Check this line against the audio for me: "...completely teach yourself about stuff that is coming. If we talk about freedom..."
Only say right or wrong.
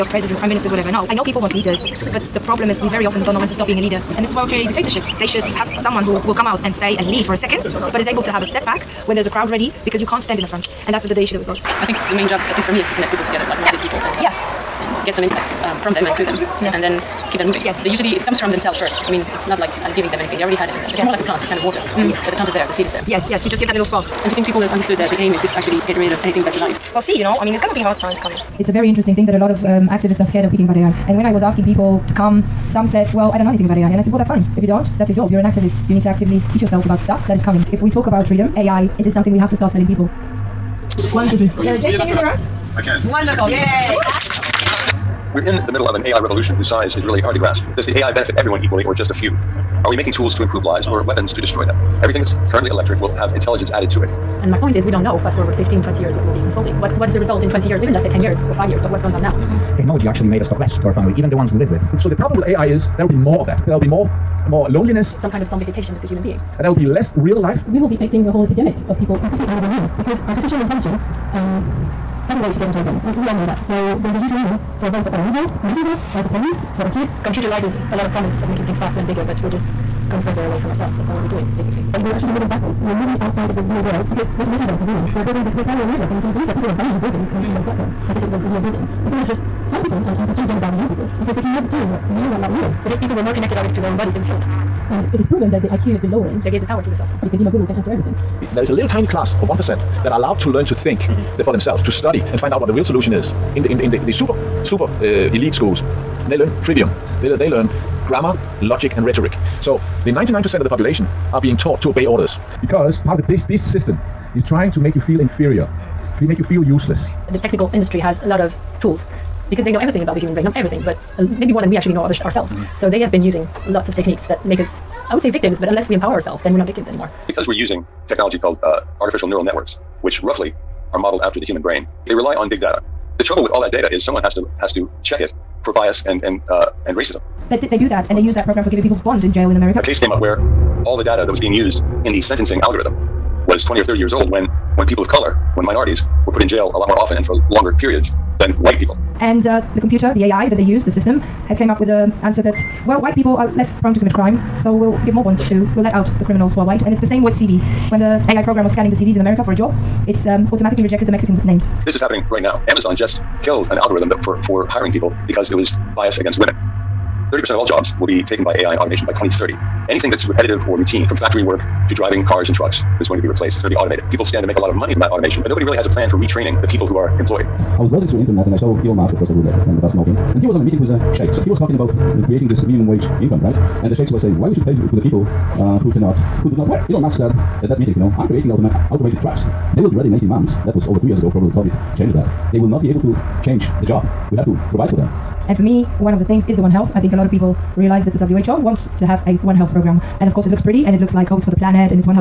wrong.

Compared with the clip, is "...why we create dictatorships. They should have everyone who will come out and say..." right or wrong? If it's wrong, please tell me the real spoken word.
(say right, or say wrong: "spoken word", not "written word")
wrong: "someone", not "everyone".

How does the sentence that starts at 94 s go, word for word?
And it is proven that the IQ has been lowering.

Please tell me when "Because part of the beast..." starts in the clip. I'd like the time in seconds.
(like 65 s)
112 s.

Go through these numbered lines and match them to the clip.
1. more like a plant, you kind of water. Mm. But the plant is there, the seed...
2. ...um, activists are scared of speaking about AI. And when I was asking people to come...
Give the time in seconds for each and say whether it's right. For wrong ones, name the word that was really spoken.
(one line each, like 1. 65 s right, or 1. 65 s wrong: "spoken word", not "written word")
1. 21 s right
2. 29 s right.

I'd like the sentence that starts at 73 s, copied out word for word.
So there's a huge warning for both our own health, mental health, as a presence for our kids.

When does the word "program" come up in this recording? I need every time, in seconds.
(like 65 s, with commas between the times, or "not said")
138 s, 158 s, 199 s.